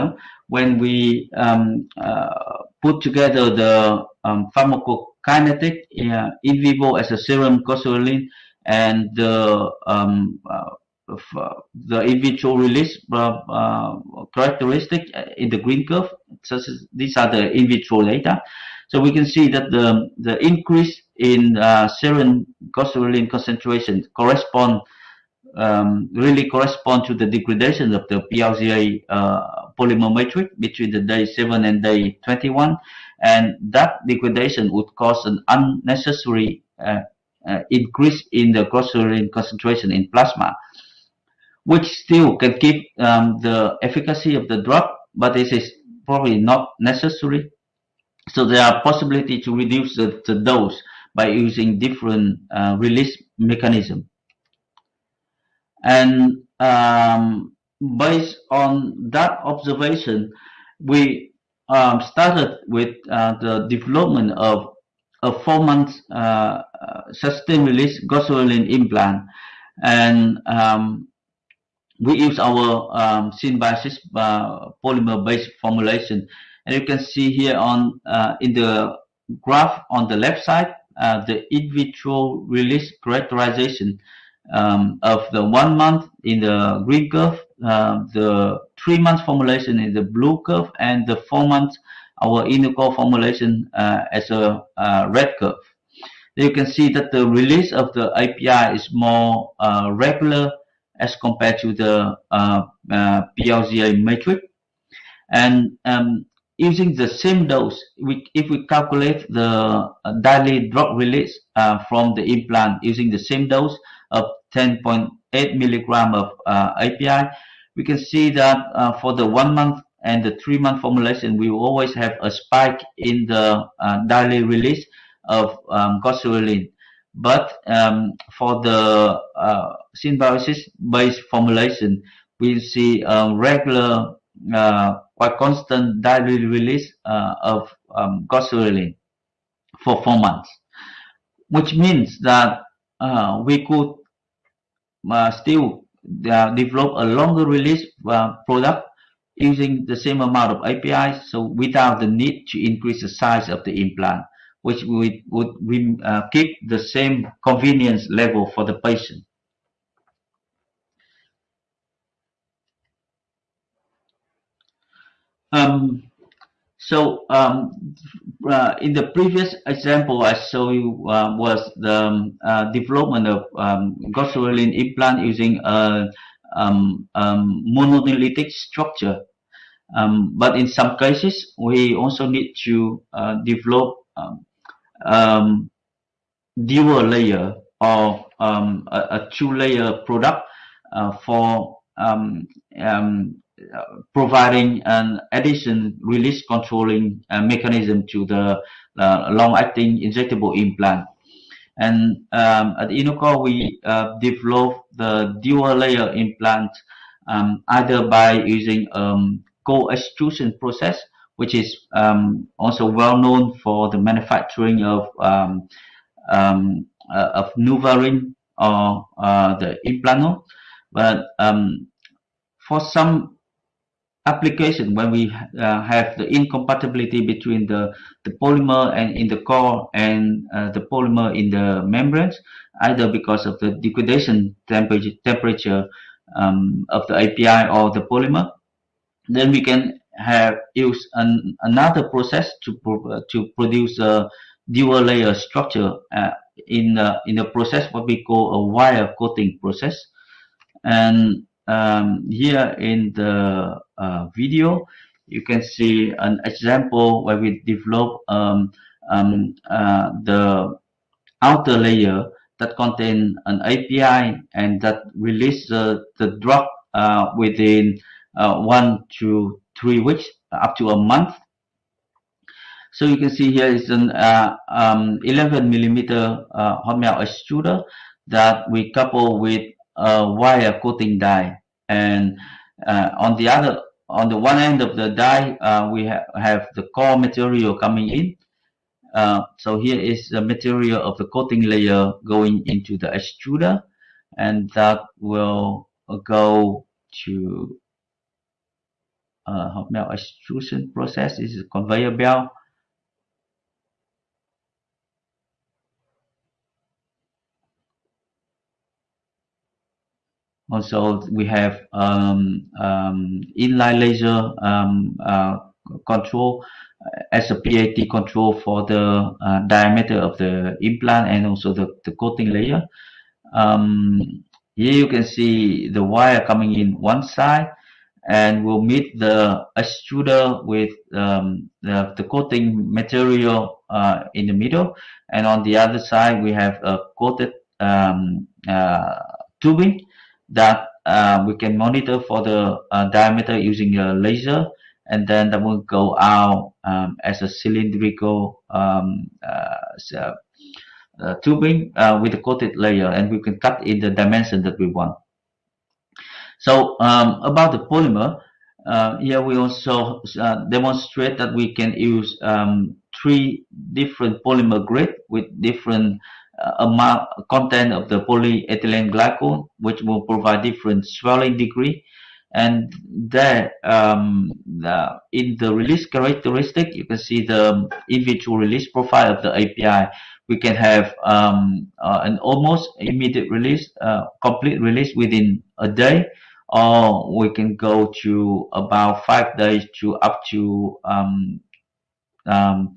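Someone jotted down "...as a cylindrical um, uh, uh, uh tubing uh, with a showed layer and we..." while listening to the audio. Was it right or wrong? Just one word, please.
wrong.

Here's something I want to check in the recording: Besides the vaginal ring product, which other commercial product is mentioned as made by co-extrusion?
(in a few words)
Implanon.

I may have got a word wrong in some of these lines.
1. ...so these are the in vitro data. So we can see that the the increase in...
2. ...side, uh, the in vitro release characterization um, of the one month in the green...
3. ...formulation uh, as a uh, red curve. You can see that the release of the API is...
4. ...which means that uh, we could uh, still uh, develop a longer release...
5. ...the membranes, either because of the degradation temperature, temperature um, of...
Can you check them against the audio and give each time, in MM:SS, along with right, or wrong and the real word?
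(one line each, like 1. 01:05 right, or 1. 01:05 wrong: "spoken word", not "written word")
1. 00:16 right
2. 01:20 right
3. 01:32 right
4. 02:21 right
5. 03:51 right.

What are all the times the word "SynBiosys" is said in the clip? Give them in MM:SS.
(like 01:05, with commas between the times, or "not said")
01:13, 02:10.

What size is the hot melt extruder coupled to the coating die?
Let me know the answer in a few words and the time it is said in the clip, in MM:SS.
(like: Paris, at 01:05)
11 millimeter, at 04:35.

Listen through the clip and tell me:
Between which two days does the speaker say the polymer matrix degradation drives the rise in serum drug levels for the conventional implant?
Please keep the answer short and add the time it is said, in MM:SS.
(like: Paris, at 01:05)
day 7 and day 21, at 00:30.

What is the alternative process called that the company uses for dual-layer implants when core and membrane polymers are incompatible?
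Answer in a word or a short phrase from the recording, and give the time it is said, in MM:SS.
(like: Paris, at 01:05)
wire coating process, at 04:08.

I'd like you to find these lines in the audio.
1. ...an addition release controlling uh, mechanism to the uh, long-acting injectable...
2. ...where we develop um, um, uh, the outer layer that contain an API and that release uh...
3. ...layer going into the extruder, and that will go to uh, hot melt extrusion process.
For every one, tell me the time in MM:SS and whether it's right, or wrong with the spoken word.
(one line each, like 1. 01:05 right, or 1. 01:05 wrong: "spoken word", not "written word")
1. 03:14 right
2. 04:17 right
3. 04:51 right.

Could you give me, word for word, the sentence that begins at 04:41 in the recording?
And uh, on the other, on the one end of the die, uh, we ha have the core material coming in.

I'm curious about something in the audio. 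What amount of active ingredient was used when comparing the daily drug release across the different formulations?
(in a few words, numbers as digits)
10.8 milligrams.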